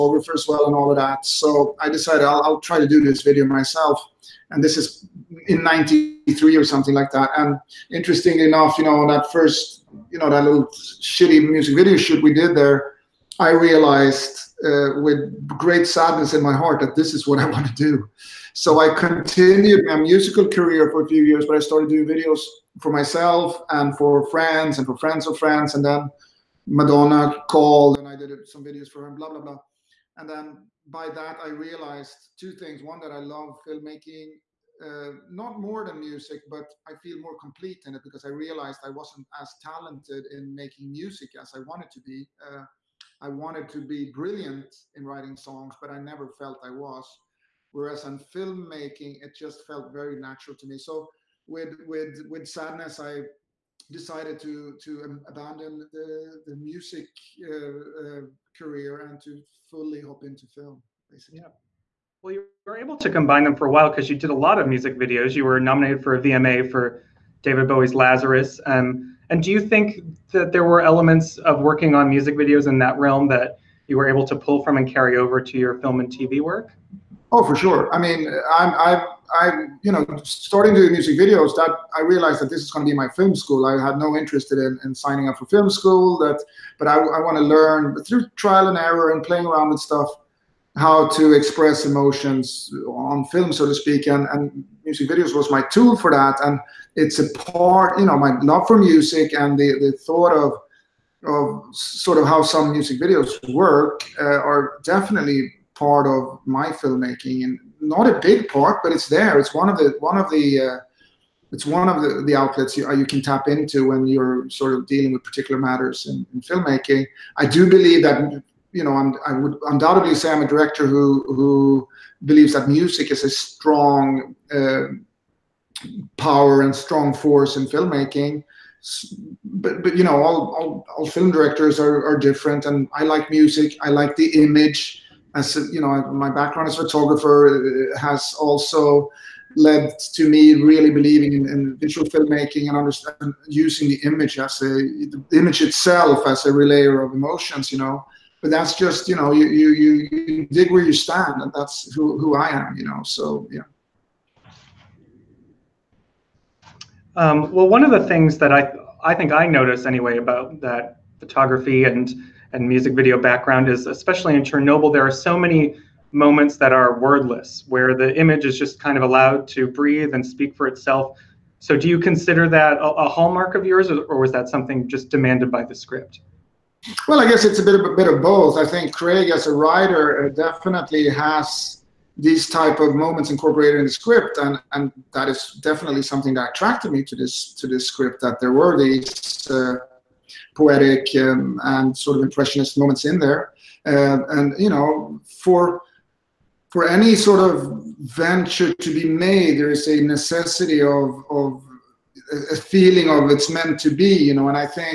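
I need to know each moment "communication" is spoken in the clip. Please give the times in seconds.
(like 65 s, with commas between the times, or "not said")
not said.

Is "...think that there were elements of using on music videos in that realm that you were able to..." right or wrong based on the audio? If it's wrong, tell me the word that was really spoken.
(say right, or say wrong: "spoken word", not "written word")
wrong: "working", not "using".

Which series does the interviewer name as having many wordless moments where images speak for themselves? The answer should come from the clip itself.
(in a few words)
Chernobyl.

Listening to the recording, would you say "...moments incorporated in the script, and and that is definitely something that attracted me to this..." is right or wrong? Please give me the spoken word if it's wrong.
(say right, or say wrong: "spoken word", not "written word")
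right.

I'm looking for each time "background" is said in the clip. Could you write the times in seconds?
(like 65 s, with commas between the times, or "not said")
136 s, 163 s.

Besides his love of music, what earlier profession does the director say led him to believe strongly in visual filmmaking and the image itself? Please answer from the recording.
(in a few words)
Photographer.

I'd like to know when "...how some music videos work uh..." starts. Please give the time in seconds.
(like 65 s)
102 s.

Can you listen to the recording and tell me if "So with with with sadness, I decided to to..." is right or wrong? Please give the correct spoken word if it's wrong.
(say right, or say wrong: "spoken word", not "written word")
right.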